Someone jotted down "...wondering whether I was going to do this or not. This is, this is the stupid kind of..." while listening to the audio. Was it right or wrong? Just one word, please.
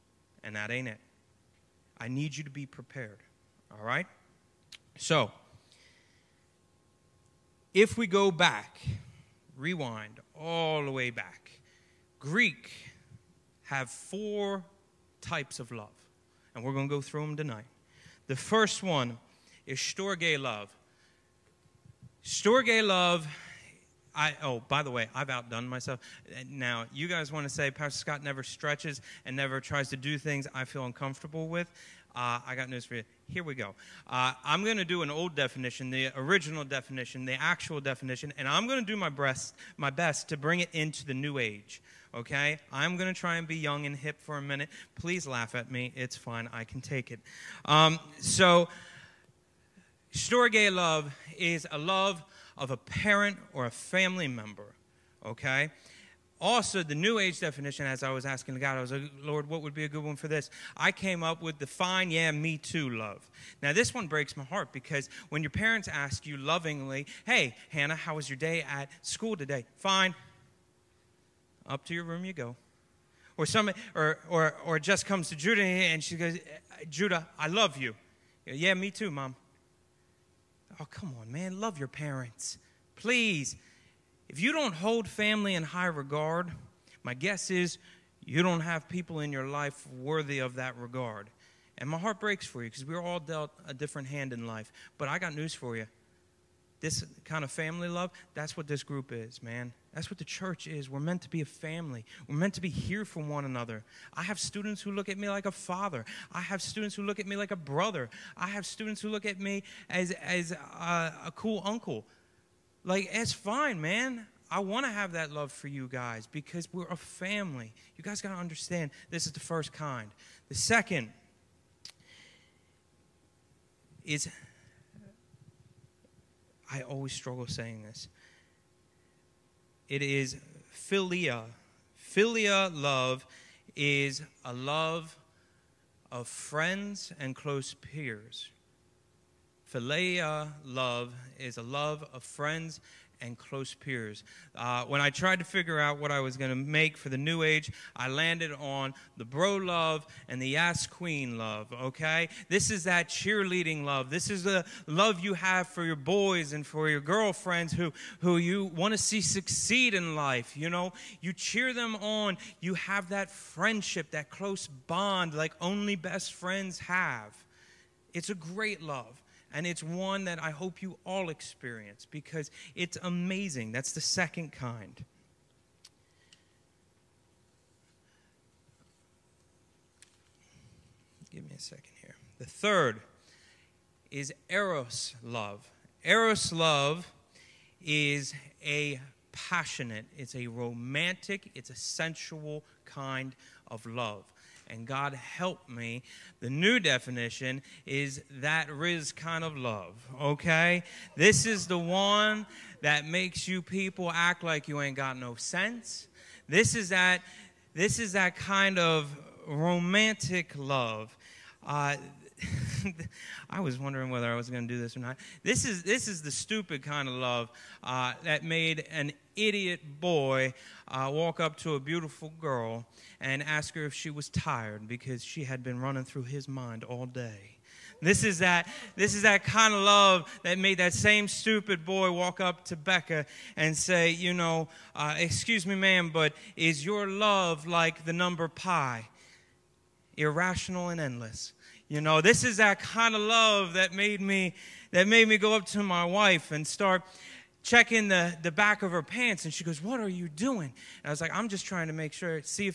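right.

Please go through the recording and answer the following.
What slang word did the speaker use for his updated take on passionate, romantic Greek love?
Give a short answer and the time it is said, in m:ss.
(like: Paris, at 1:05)
Rizz, at 3:18.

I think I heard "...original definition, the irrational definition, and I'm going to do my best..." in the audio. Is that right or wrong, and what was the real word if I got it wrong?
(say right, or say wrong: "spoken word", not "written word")
wrong: "actual", not "irrational".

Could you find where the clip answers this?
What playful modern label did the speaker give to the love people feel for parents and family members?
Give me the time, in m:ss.
1:01.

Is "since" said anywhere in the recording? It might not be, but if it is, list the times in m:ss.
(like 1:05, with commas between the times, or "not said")
not said.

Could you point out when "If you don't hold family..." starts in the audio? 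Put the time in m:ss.
1:24.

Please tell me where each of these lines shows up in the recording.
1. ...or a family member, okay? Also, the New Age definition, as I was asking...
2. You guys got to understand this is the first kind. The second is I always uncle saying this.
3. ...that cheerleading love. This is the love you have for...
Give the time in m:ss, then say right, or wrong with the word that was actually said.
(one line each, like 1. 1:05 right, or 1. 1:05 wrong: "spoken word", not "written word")
1. 0:53 right
2. 1:57 wrong: "struggle", not "uncle"
3. 2:32 right.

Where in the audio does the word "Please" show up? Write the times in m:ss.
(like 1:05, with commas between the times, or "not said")
0:44, 1:22.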